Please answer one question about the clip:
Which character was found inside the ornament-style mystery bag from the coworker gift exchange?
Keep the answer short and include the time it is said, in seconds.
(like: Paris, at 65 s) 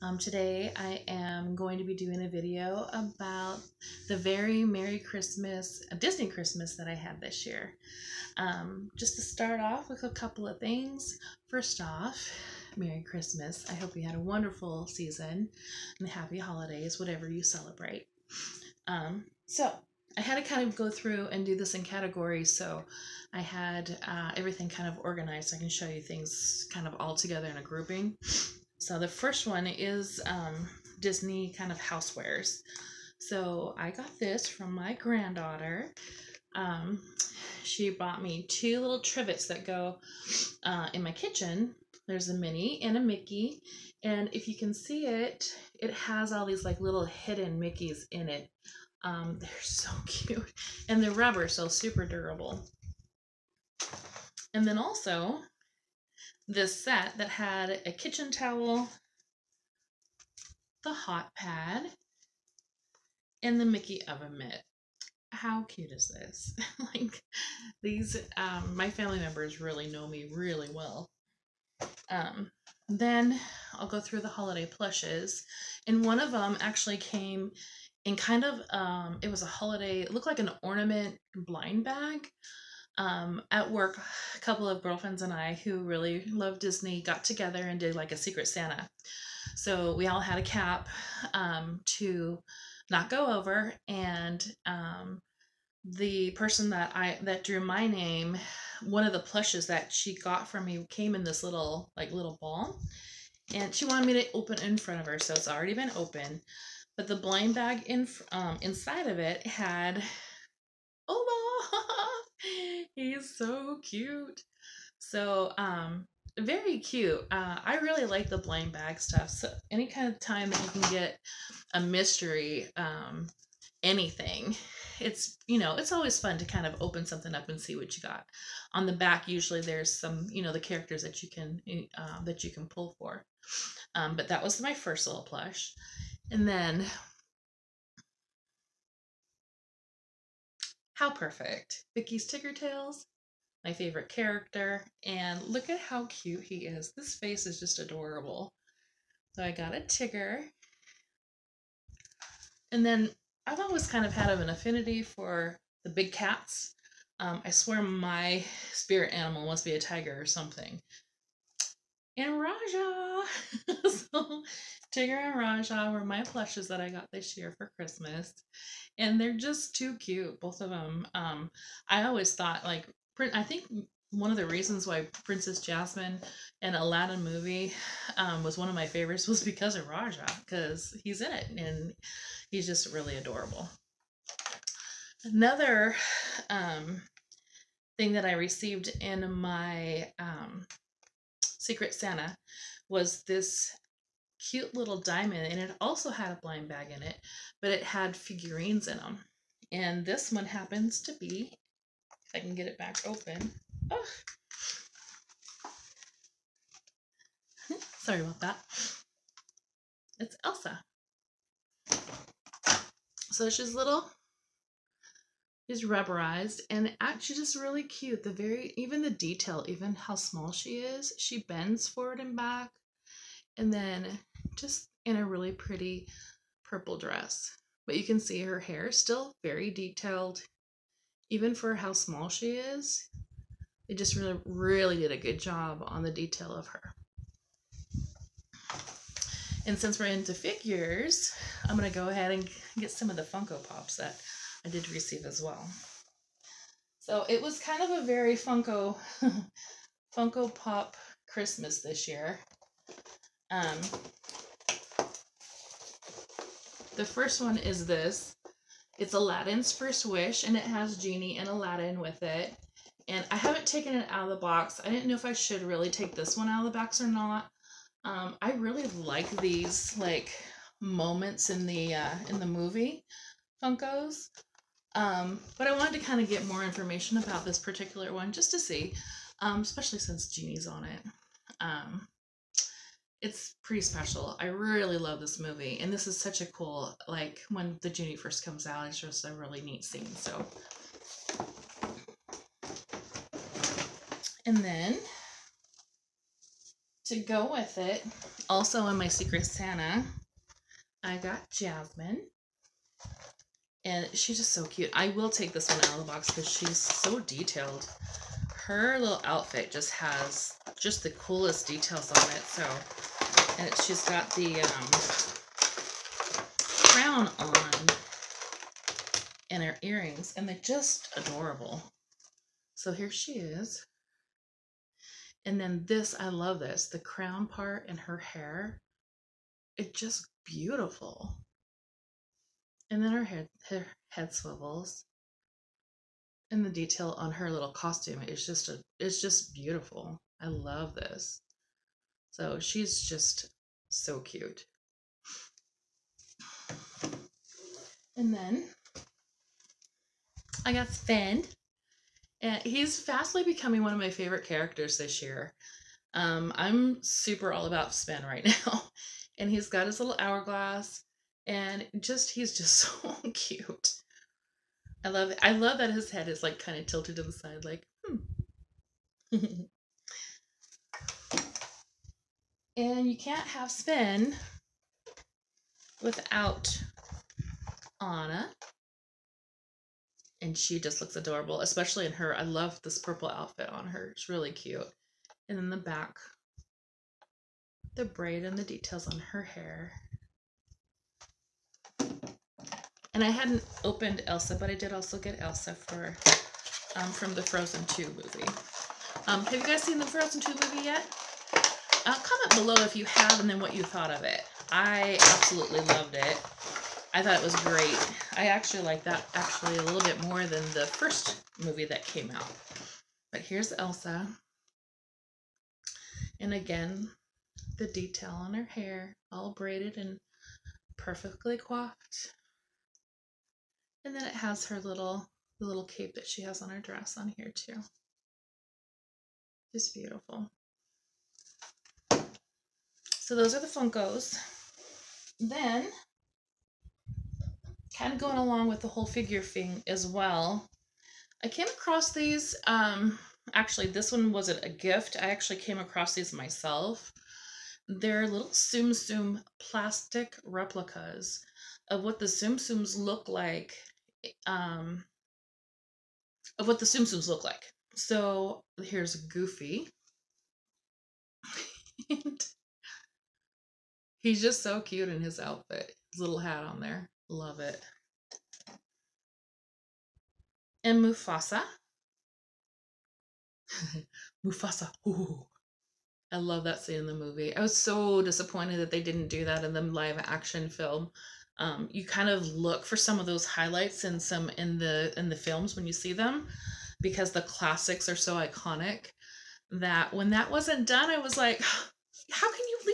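Oma, at 111 s.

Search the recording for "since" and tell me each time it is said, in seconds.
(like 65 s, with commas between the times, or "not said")
239 s, 279 s.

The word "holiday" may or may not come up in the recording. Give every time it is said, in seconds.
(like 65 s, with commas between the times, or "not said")
16 s, 74 s, 79 s.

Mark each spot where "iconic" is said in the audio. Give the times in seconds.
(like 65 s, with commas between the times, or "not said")
488 s.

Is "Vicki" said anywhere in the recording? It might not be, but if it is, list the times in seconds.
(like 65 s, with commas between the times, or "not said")
141 s.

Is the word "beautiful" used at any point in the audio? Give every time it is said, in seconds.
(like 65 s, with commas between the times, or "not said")
330 s, 339 s, 429 s.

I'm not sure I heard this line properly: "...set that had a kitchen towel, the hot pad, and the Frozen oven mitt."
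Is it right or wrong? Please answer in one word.
wrong.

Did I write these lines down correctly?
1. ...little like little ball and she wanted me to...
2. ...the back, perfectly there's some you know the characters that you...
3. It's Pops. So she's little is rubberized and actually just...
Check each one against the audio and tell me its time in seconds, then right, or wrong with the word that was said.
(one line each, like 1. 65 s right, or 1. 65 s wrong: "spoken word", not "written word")
1. 101 s right
2. 128 s wrong: "usually", not "perfectly"
3. 210 s wrong: "Elsa", not "Pops".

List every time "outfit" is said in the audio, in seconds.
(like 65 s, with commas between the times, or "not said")
309 s, 383 s, 465 s.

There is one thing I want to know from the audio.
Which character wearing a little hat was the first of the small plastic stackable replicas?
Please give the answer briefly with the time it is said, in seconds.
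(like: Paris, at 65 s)
Goofy, at 459 s.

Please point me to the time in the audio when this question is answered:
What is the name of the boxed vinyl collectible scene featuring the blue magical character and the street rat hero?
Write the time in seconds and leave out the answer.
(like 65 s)
259 s.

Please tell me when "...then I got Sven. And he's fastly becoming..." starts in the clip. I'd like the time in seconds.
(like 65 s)
348 s.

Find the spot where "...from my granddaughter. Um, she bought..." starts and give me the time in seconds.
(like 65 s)
34 s.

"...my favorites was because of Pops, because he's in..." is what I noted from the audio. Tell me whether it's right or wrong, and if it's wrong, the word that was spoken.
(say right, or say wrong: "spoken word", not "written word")
wrong: "Rajah", not "Pops".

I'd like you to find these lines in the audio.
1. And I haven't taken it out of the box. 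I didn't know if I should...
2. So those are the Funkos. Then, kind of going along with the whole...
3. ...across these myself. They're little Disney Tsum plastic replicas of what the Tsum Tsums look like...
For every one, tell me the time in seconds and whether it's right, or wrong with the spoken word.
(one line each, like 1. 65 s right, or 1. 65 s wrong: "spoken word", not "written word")
1. 263 s right
2. 433 s right
3. 445 s wrong: "Tsum", not "Disney".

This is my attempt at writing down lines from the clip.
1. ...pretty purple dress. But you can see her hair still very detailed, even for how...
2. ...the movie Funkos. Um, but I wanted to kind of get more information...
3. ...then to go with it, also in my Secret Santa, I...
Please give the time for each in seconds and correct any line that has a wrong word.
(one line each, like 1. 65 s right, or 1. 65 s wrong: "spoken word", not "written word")
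1. 225 s right
2. 272 s right
3. 294 s right.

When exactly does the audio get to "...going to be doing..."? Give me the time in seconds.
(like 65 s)
1 s.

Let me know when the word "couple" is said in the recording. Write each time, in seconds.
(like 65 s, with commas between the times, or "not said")
10 s, 84 s.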